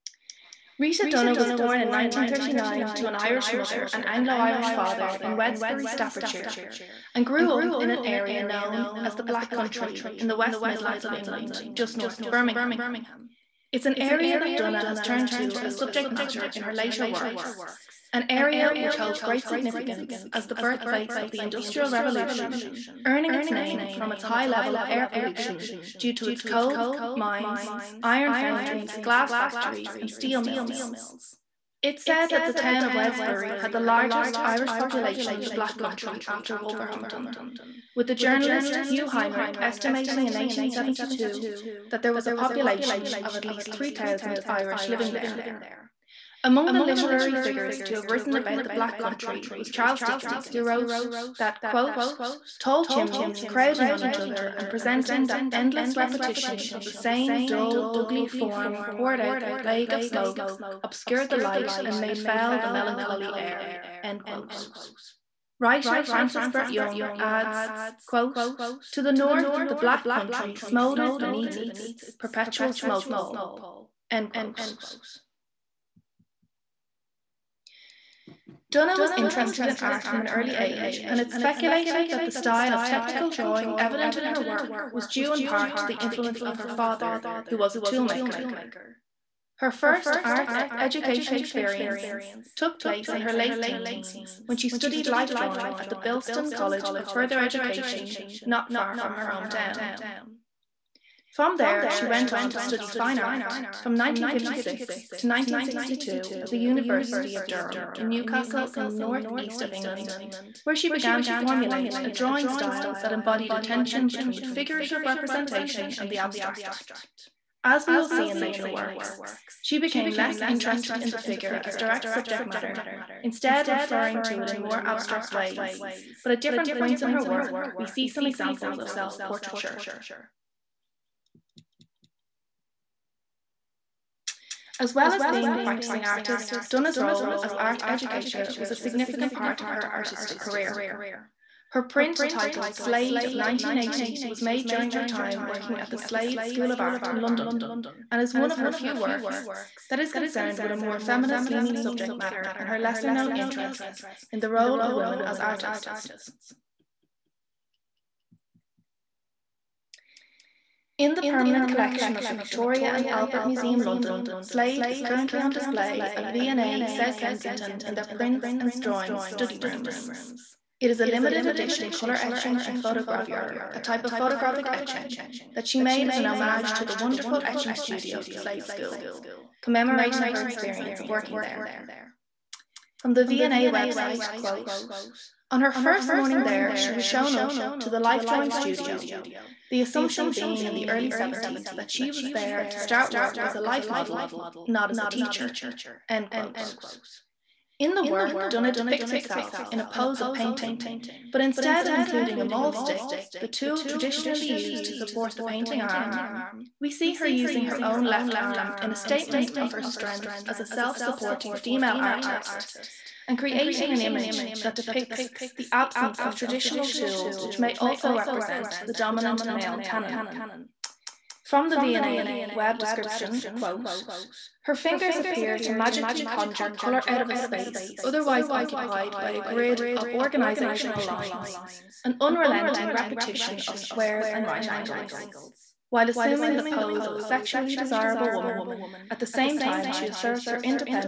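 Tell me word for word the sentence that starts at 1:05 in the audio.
Writer Francis Brett Young adds, quote, To the north, the black country smouldered beneath its perpetual smoke pall.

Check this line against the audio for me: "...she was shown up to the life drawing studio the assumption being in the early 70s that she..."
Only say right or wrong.
right.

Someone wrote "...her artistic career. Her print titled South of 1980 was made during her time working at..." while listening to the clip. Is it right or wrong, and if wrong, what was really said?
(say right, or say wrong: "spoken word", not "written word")
wrong: "Slade", not "South".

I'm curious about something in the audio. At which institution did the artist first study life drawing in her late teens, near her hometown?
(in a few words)
Bilston College of Further Education.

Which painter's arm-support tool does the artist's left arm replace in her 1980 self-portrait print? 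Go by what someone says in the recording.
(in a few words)
maul stick.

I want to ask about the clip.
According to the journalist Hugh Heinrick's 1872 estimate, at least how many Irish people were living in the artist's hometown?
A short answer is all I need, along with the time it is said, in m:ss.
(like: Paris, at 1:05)
3,000, at 0:43.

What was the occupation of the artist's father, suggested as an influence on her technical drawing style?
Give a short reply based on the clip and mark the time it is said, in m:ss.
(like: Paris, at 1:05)
toolmaker, at 1:27.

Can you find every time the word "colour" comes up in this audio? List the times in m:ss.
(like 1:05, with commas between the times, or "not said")
2:51, 3:46.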